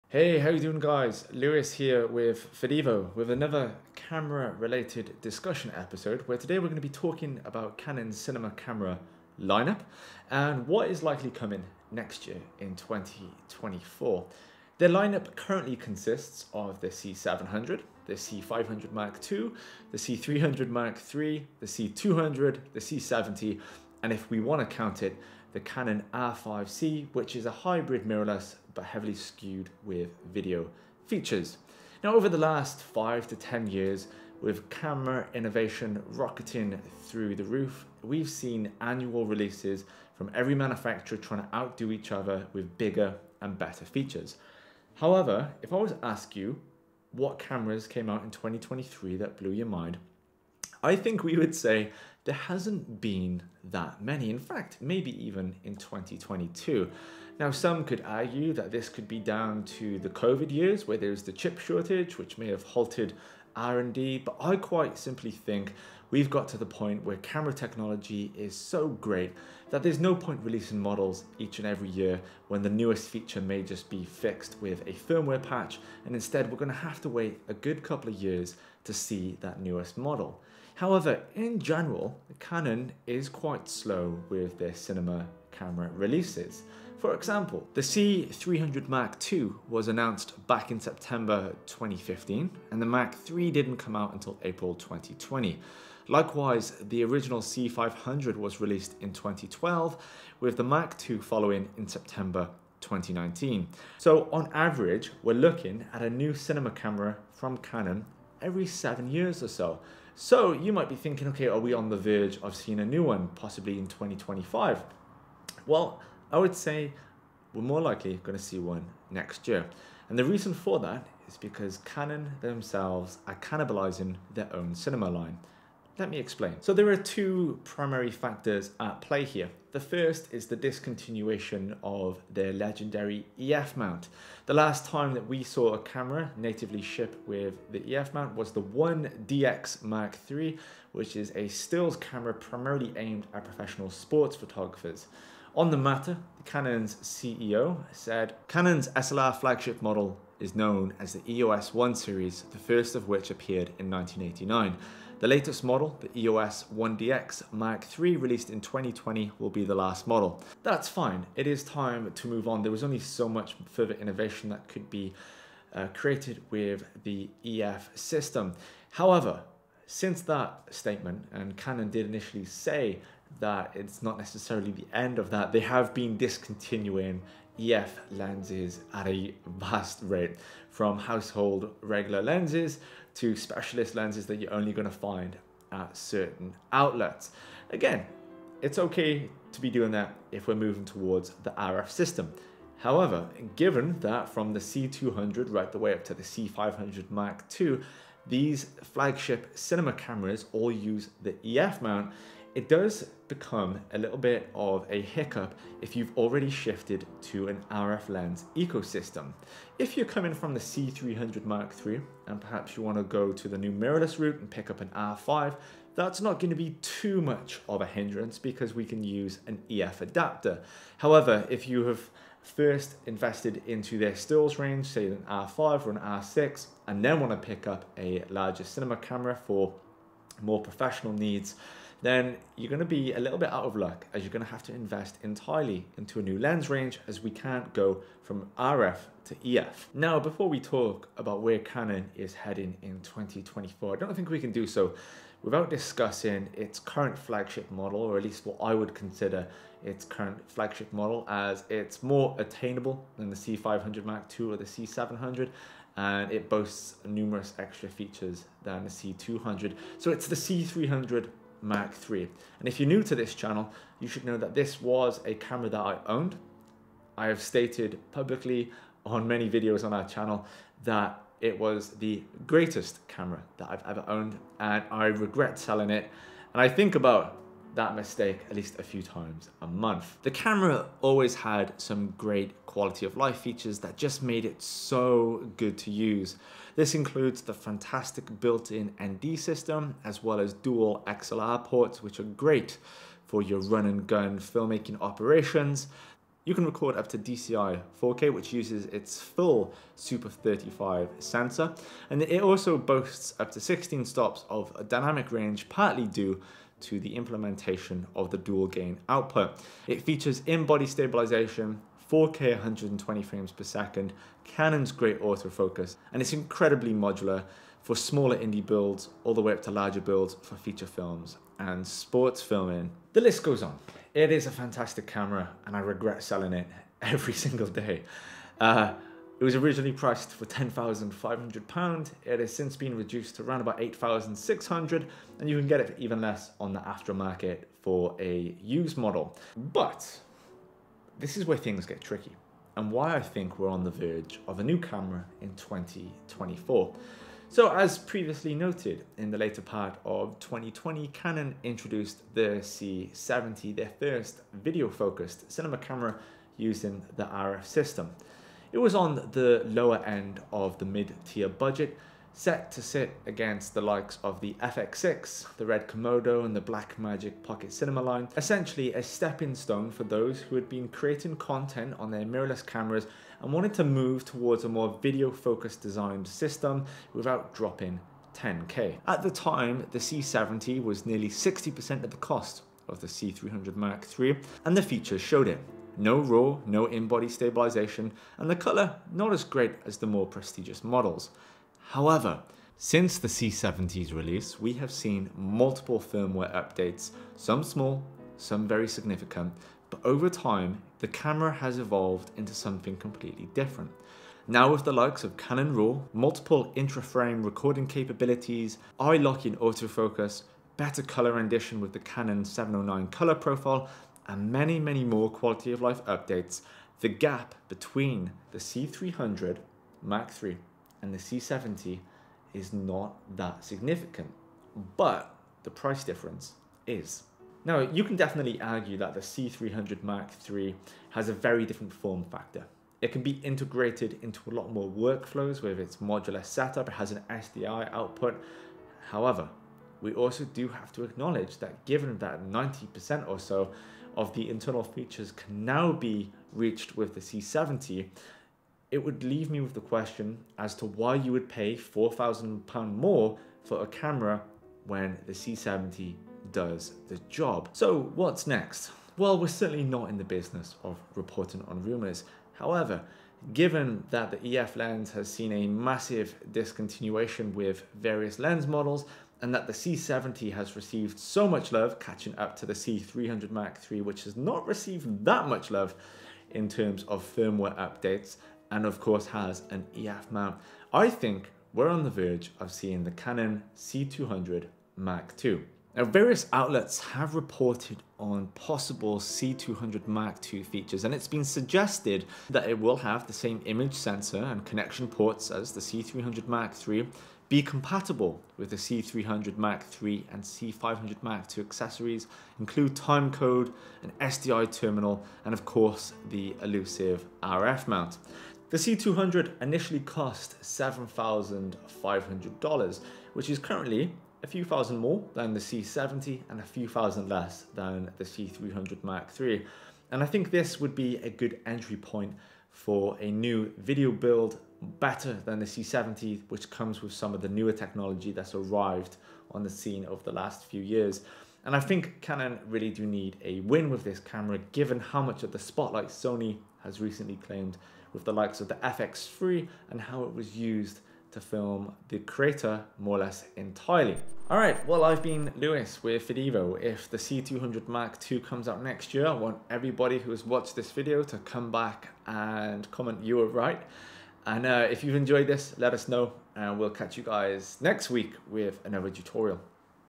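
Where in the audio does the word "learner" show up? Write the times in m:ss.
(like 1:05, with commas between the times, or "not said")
not said.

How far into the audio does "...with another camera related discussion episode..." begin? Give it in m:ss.
0:03.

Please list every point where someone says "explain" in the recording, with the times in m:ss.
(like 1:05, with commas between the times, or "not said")
2:06.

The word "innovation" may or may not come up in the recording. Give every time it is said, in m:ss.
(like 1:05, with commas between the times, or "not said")
0:35, 2:43.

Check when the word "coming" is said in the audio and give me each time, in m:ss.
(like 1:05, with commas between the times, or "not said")
0:11, 3:30.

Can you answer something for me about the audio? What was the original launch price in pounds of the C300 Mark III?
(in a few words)
£10,500.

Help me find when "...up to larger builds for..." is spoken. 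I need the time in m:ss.
5:19.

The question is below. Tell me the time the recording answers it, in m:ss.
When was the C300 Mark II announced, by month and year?
1:30.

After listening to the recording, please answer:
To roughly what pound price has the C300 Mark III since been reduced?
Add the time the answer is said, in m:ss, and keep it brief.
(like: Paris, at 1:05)
£8,600, at 5:33.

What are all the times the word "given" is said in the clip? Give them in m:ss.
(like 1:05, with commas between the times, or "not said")
3:13, 7:21, 7:43, 8:54.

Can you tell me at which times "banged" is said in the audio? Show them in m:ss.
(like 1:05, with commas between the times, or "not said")
not said.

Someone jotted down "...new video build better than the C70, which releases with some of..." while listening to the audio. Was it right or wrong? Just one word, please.
wrong.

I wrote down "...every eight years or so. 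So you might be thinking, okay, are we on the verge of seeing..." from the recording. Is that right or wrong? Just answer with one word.
wrong.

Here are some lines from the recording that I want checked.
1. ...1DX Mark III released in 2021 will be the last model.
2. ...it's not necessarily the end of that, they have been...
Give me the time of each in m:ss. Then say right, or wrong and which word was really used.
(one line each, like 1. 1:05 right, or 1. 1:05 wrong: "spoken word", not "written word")
1. 2:36 wrong: "2020", not "2021"
2. 2:53 right.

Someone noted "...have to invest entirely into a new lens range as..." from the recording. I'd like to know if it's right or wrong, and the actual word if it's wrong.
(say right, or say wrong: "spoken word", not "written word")
right.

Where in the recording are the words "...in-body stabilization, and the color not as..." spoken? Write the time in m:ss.
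6:26.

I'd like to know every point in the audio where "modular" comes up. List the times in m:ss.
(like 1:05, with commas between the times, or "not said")
5:16, 7:15.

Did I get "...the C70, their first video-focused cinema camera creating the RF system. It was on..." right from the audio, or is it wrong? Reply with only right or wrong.
wrong.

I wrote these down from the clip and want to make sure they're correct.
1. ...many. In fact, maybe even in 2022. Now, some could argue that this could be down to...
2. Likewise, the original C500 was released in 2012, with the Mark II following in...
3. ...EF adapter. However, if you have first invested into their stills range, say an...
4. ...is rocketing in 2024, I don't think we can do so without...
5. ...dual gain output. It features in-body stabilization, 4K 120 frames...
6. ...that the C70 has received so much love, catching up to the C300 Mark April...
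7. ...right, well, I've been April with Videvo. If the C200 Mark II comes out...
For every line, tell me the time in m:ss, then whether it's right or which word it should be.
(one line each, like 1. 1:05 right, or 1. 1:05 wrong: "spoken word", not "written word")
1. 0:54 right
2. 1:36 right
3. 3:39 right
4. 4:02 wrong: "heading", not "rocketing"
5. 5:08 right
6. 7:49 wrong: "III", not "April"
7. 9:04 wrong: "Lewis", not "April".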